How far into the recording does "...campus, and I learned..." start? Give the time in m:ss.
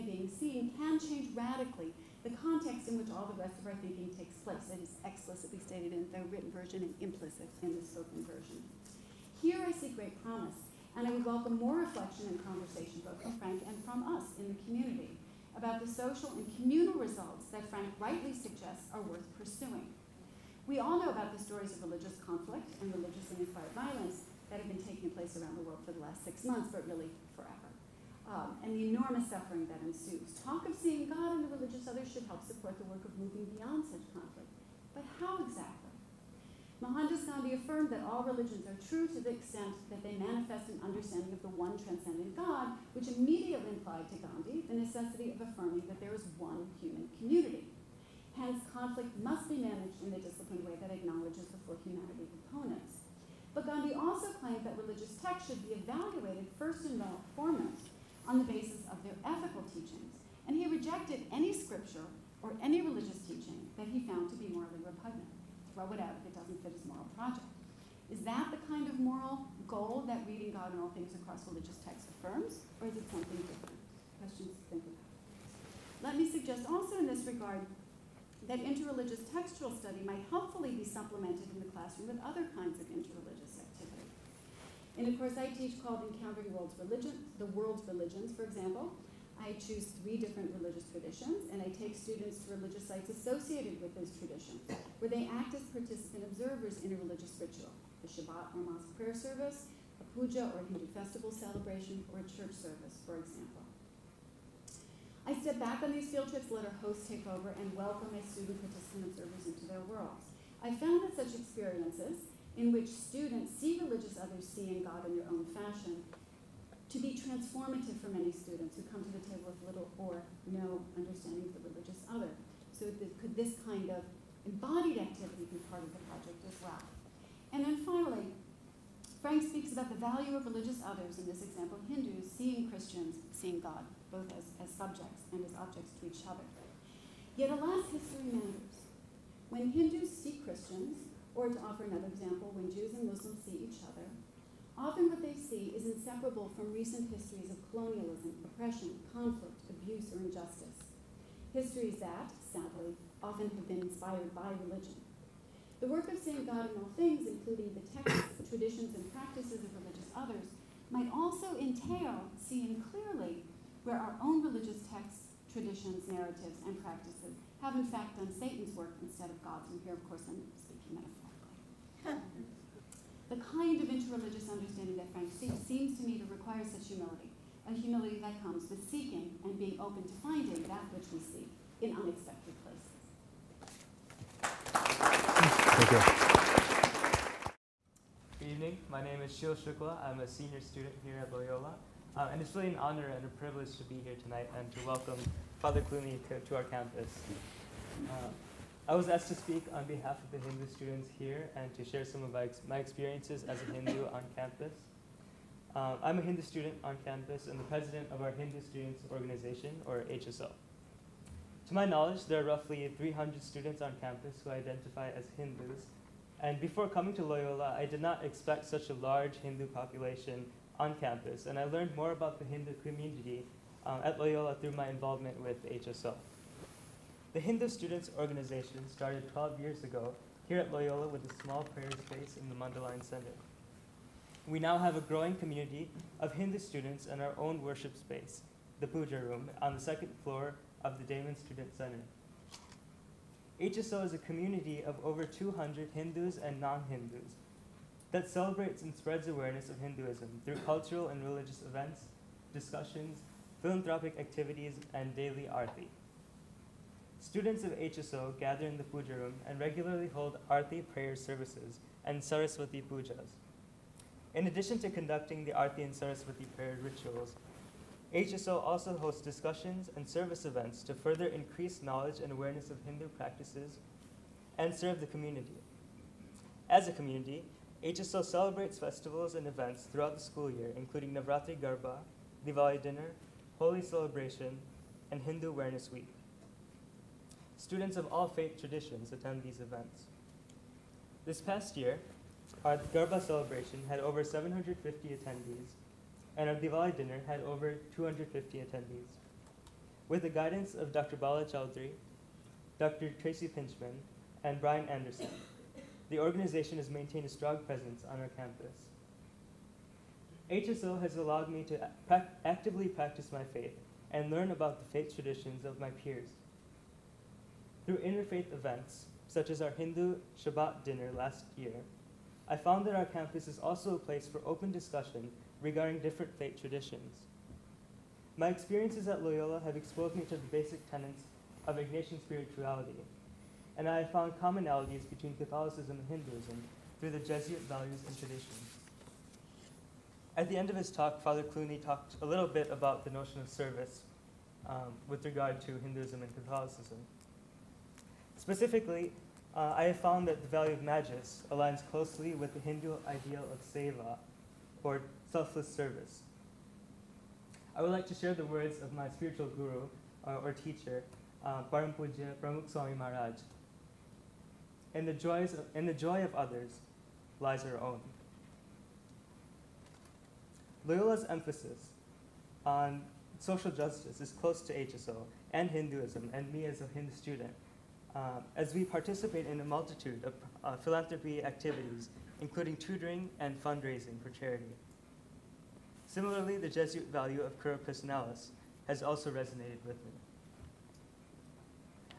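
3:40.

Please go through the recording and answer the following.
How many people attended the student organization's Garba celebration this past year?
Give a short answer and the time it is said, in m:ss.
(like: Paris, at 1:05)
750, at 4:54.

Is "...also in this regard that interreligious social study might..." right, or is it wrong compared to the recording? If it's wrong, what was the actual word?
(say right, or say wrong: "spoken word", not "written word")
wrong: "textual", not "social".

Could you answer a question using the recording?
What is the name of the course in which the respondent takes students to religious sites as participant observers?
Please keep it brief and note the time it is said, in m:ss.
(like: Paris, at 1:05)
Encountering World's Religion, at 1:26.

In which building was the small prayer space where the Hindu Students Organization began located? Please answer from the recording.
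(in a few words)
Mundelein Center.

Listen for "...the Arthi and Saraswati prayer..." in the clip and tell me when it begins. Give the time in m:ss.
4:25.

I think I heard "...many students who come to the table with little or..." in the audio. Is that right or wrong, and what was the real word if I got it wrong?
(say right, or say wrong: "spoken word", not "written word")
right.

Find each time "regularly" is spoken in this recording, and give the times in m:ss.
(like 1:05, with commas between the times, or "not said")
4:19.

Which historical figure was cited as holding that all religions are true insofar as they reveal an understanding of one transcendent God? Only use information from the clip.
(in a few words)
Mohandas Gandhi.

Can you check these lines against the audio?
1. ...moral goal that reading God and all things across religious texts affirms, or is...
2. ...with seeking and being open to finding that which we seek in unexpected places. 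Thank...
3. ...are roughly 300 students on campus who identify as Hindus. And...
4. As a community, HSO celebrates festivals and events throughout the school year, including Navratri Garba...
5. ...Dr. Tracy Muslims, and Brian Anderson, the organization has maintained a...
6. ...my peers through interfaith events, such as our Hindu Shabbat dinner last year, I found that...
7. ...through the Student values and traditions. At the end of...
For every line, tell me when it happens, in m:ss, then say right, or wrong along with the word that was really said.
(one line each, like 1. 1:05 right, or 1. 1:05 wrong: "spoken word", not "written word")
1. 1:08 right
2. 2:58 right
3. 3:32 right
4. 4:36 right
5. 5:02 wrong: "Pintchman", not "Muslims"
6. 5:15 right
7. 5:37 wrong: "Jesuit", not "Student".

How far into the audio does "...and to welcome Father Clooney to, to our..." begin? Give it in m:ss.
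3:14.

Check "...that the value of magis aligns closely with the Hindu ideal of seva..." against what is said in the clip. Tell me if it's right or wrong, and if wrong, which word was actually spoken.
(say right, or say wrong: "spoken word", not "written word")
right.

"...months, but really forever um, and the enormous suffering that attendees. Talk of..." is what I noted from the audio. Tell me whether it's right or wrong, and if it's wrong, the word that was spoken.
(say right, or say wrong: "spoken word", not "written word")
wrong: "ensues", not "attendees".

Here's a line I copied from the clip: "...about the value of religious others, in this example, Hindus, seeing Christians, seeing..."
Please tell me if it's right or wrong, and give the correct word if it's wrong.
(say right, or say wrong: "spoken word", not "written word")
right.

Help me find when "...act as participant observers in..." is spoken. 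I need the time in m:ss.
1:35.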